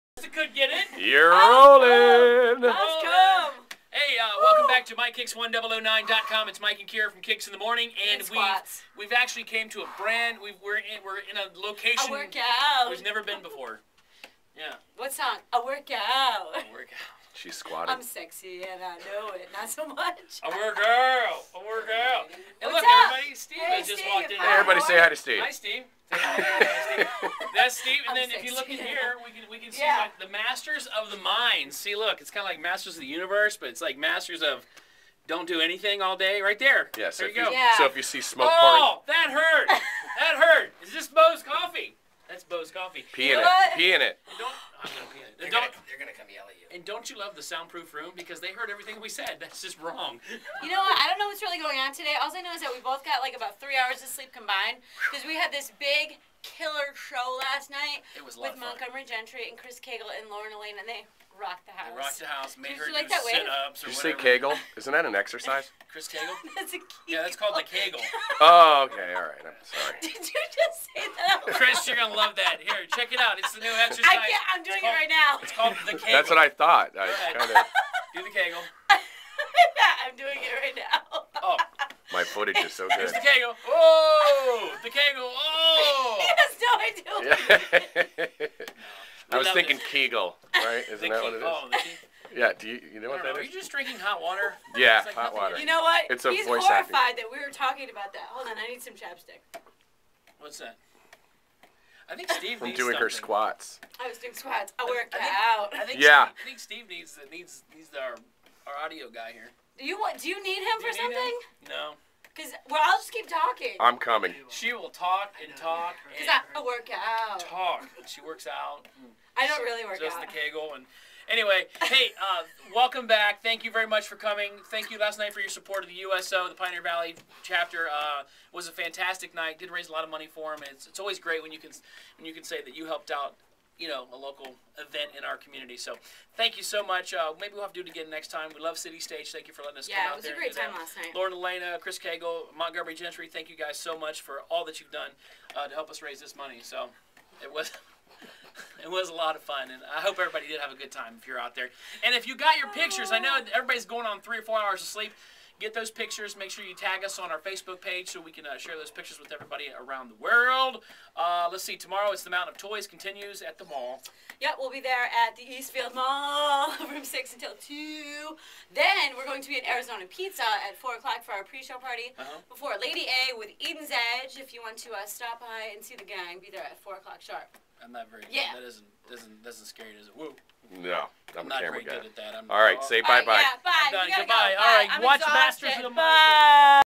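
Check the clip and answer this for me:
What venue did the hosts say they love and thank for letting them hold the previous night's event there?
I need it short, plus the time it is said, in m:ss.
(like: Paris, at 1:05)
City Stage, at 2:18.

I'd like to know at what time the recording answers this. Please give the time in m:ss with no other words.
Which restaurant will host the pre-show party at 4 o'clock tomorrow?
2:49.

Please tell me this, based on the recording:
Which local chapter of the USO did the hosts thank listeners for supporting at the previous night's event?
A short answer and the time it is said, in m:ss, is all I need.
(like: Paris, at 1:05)
Pioneer Valley, at 2:06.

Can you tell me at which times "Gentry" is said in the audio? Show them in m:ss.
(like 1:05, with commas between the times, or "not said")
0:59, 2:22.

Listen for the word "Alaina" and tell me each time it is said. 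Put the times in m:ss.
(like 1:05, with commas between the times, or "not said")
1:00, 2:21.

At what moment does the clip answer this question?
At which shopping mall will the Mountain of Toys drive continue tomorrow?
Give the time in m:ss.
2:45.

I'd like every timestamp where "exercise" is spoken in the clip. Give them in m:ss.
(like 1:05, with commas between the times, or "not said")
1:05, 1:13.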